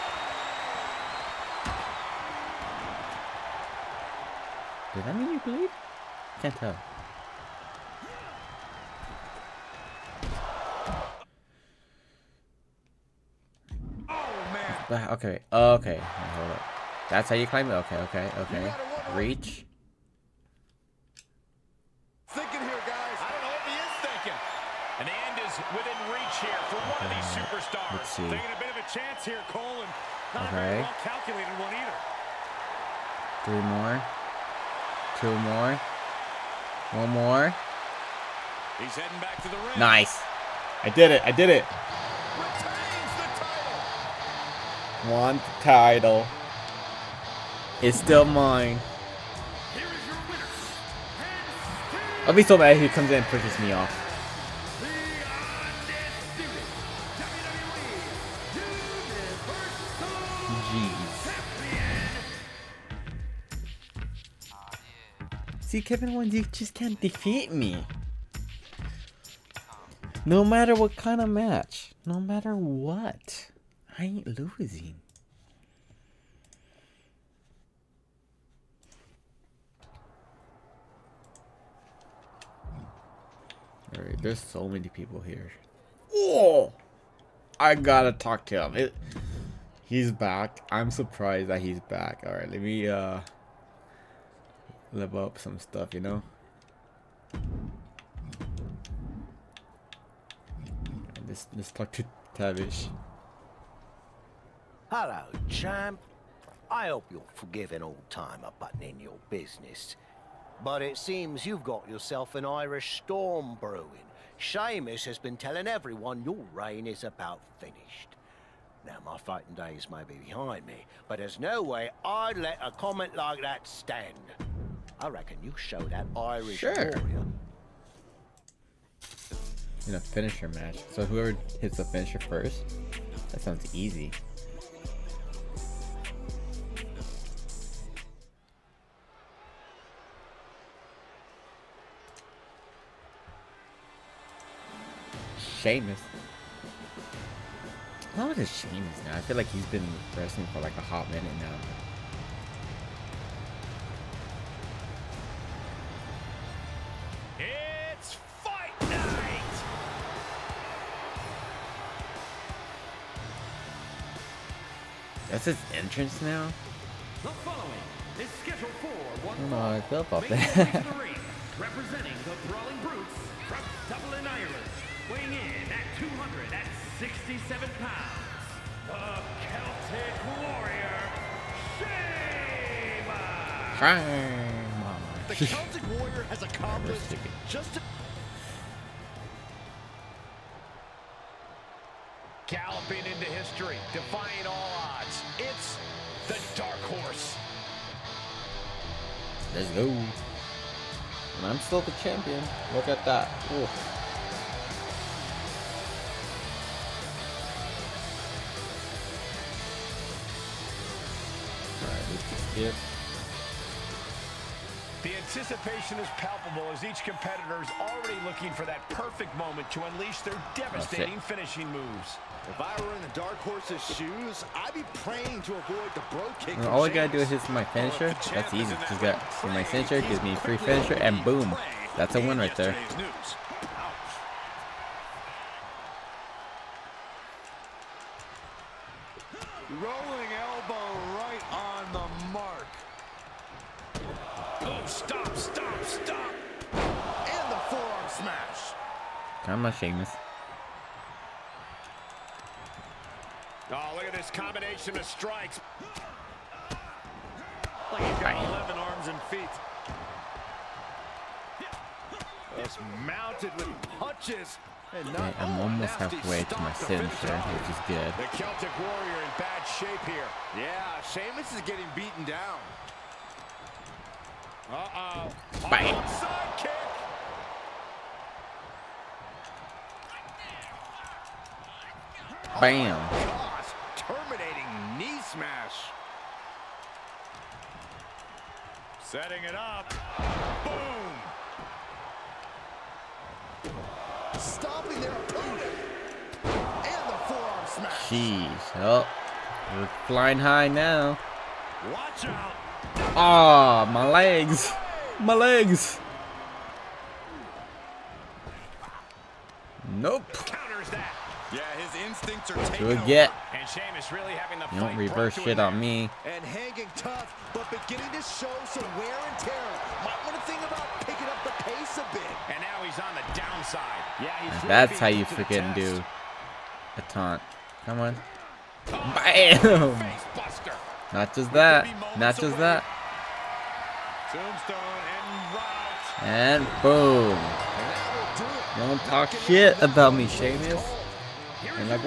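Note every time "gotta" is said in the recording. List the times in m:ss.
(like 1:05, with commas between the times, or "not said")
1:27, 3:46.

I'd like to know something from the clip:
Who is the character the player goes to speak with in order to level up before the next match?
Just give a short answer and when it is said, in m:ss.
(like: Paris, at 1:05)
Tavish, at 1:42.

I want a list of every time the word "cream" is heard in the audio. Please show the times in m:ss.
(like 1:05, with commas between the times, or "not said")
not said.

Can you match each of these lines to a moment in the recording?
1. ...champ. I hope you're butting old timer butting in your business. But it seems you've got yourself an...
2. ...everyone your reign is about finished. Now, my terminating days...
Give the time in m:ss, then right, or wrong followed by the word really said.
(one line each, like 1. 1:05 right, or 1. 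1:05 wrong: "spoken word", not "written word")
1. 1:45 wrong: "forgiving", not "butting"
2. 1:55 wrong: "fighting", not "terminating".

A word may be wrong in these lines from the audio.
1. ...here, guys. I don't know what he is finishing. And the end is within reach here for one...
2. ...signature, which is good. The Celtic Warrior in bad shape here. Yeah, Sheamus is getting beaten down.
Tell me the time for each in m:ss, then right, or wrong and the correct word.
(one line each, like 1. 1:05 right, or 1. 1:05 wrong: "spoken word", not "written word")
1. 0:22 wrong: "thinking", not "finishing"
2. 4:26 right.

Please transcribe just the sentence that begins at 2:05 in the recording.
I reckon you show that Irish sure.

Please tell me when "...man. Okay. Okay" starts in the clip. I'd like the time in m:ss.
0:14.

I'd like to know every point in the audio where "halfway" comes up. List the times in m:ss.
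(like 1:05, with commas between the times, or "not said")
4:25.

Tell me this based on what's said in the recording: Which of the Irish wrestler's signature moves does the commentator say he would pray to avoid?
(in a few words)
Brogue Kick.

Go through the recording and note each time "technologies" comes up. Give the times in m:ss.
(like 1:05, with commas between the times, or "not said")
not said.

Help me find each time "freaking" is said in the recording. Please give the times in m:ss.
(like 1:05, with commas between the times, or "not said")
5:25.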